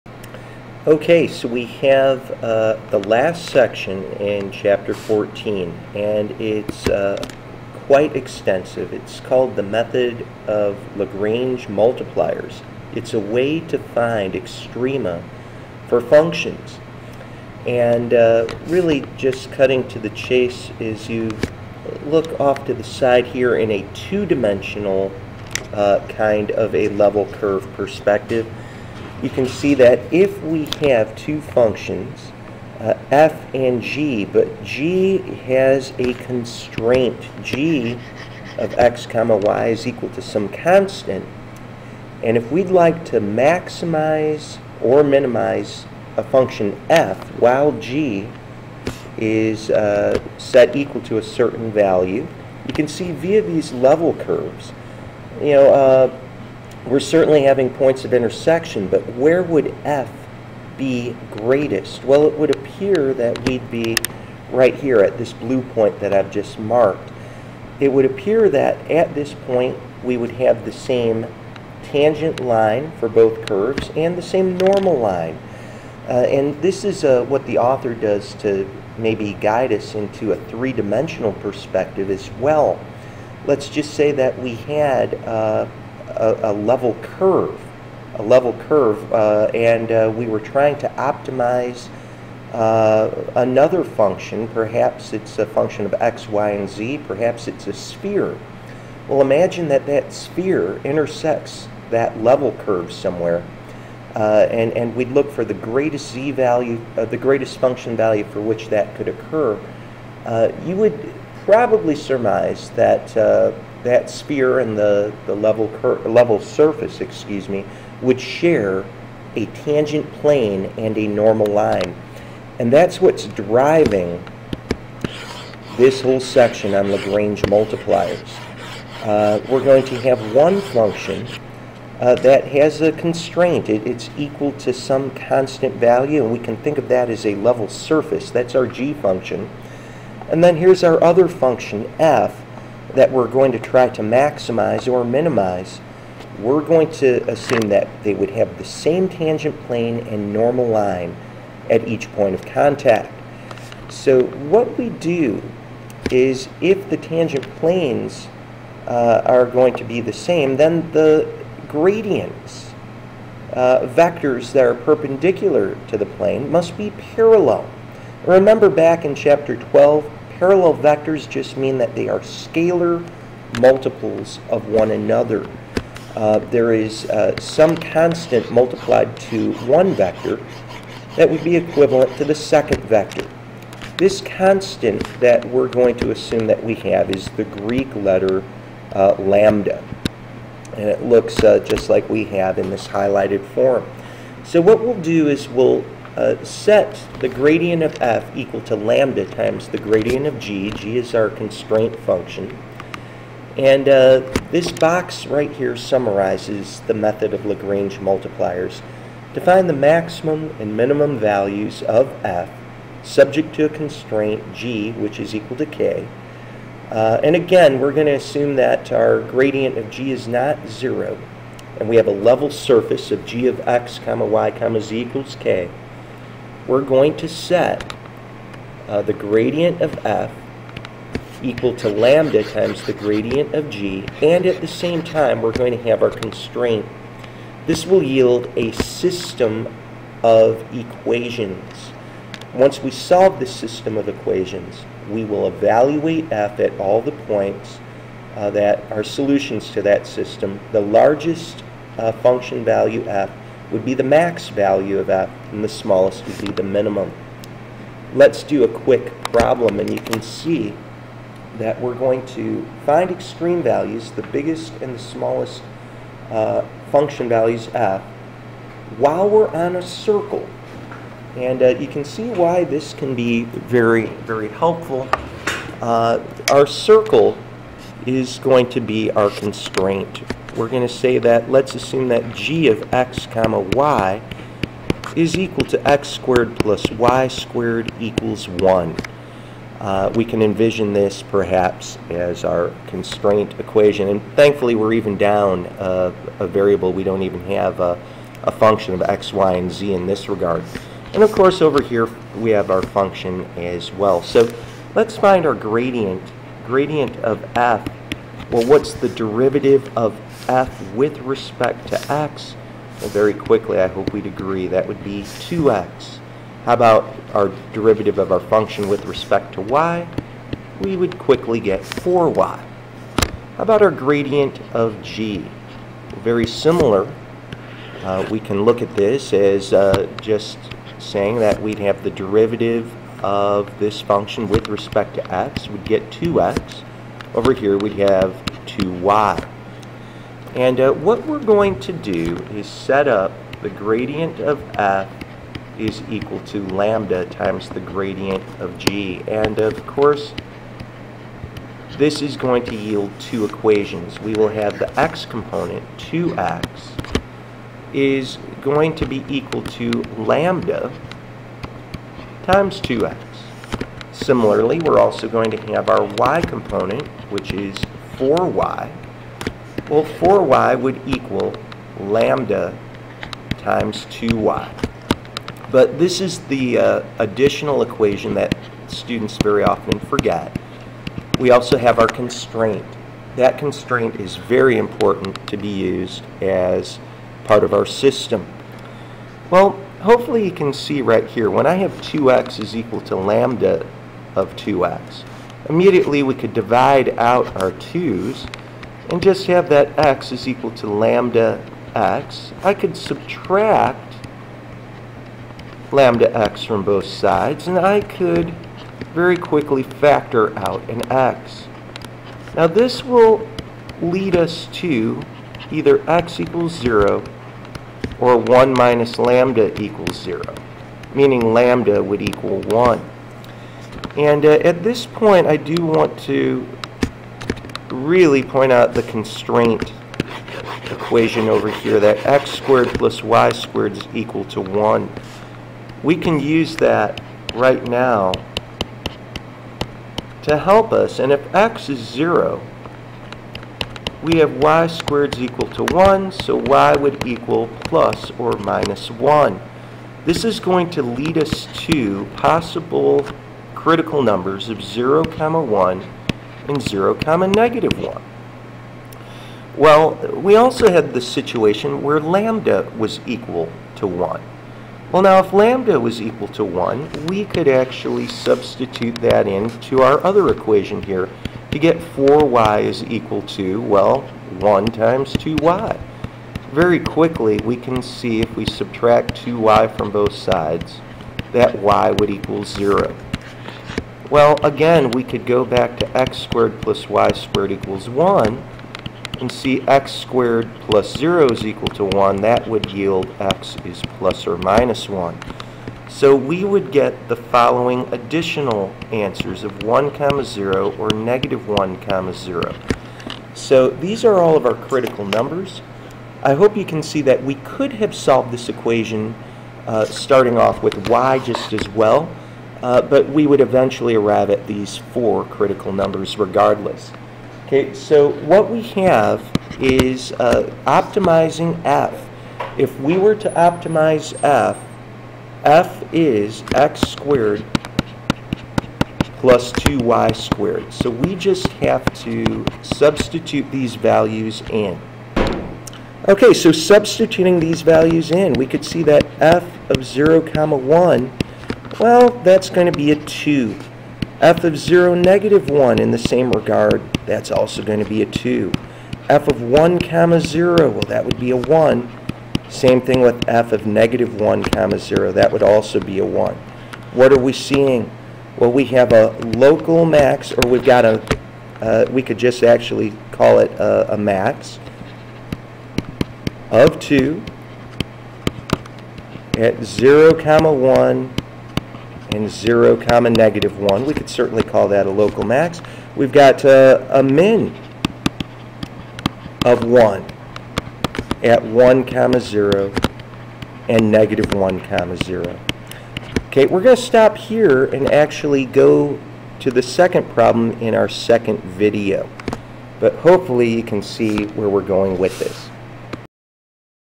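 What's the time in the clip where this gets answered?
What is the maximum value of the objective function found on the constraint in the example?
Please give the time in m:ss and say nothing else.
9:24.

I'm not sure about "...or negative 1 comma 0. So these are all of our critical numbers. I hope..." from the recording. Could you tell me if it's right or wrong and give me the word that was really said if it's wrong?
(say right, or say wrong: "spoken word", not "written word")
right.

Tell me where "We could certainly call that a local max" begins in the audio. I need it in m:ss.
9:34.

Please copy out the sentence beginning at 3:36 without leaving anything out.
Uh, and again, we're going to assume that our gradient of g is not 0.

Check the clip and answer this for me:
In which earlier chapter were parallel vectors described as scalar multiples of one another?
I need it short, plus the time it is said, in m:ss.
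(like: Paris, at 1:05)
12, at 2:49.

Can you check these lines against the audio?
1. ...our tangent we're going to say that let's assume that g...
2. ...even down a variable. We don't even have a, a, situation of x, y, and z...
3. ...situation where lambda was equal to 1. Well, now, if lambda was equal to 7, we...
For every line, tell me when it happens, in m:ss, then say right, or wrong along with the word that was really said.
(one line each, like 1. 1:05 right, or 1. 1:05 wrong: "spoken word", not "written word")
1. 4:39 wrong: "constraint", not "tangent"
2. 4:54 wrong: "function", not "situation"
3. 7:41 wrong: "1", not "7".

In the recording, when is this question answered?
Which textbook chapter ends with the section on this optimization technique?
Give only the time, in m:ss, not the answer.
0:04.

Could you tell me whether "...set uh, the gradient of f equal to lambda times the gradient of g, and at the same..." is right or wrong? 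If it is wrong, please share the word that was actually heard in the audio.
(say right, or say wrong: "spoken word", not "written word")
right.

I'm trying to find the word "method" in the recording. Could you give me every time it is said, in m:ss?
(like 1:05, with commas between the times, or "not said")
0:09, 3:26.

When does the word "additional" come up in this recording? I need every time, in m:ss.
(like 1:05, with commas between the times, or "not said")
6:17, 8:18.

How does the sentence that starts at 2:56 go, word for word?
Uh, there is uh, some constant multiplied to one vector that would be equivalent to the second vector.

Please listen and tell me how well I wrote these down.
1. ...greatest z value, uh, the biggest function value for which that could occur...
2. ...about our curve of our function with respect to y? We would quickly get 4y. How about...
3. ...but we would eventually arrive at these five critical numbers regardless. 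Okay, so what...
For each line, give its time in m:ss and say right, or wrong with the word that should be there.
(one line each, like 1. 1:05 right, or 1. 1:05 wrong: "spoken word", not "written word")
1. 1:45 wrong: "greatest", not "biggest"
2. 5:16 wrong: "derivative", not "curve"
3. 8:33 wrong: "four", not "five".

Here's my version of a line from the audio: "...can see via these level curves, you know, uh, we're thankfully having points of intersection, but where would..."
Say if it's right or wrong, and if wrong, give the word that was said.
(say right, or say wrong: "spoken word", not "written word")
wrong: "certainly", not "thankfully".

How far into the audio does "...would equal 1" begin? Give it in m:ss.
7:02.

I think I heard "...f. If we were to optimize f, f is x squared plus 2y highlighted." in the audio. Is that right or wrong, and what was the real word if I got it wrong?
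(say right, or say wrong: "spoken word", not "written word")
wrong: "squared", not "highlighted".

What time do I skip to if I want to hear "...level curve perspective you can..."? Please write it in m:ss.
0:26.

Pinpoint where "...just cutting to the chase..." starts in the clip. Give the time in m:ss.
0:19.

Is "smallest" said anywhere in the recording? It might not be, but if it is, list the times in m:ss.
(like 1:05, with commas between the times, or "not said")
4:15, 4:24.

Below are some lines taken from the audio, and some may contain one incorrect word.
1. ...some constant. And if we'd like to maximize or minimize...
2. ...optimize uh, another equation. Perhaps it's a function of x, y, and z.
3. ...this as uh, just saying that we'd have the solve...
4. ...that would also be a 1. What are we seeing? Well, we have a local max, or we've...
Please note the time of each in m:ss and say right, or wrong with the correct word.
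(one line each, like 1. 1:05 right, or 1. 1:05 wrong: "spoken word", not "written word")
1. 0:40 right
2. 1:30 wrong: "function", not "equation"
3. 5:28 wrong: "derivative", not "solve"
4. 9:15 right.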